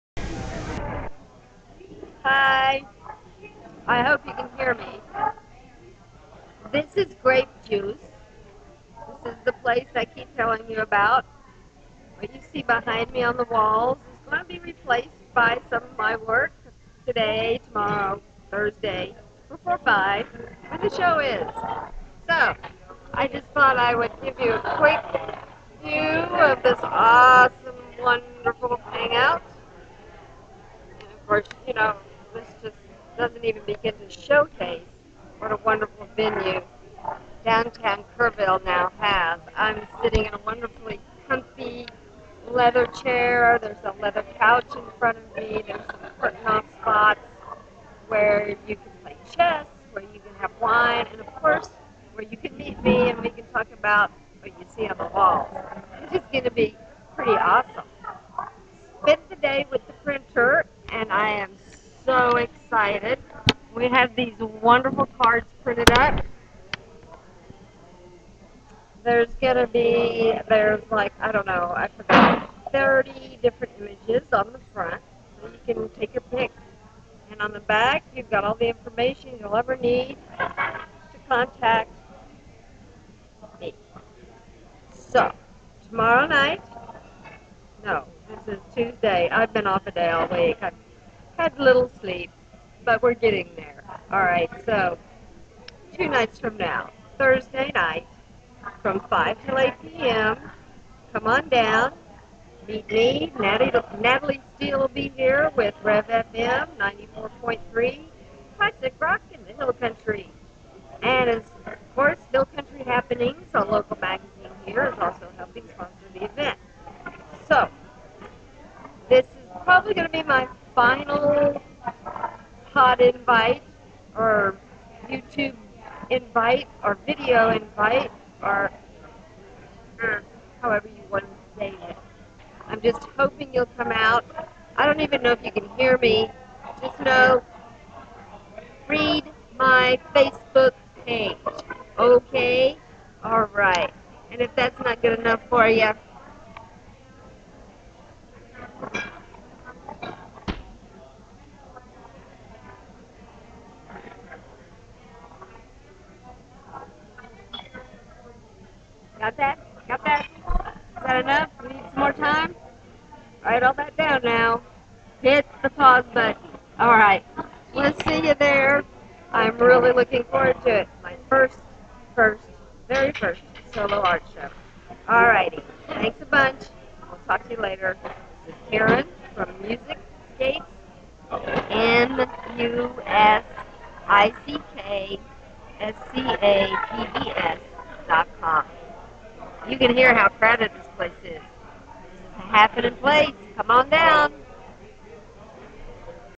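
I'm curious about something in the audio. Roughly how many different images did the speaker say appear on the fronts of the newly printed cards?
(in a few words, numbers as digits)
30.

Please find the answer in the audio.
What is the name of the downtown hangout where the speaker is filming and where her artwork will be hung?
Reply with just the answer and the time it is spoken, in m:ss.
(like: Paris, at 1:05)
Grape Juice, at 0:07.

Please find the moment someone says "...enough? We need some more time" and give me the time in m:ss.
2:41.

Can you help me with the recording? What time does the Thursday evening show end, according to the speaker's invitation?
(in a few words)
8 p.m.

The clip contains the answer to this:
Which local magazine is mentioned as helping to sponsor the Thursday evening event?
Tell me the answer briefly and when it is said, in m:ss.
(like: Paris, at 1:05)
Hill Country Happenings, at 1:52.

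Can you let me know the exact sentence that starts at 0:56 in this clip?
It's just going to be pretty awesome.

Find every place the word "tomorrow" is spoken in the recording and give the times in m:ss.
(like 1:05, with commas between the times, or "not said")
0:17, 1:25.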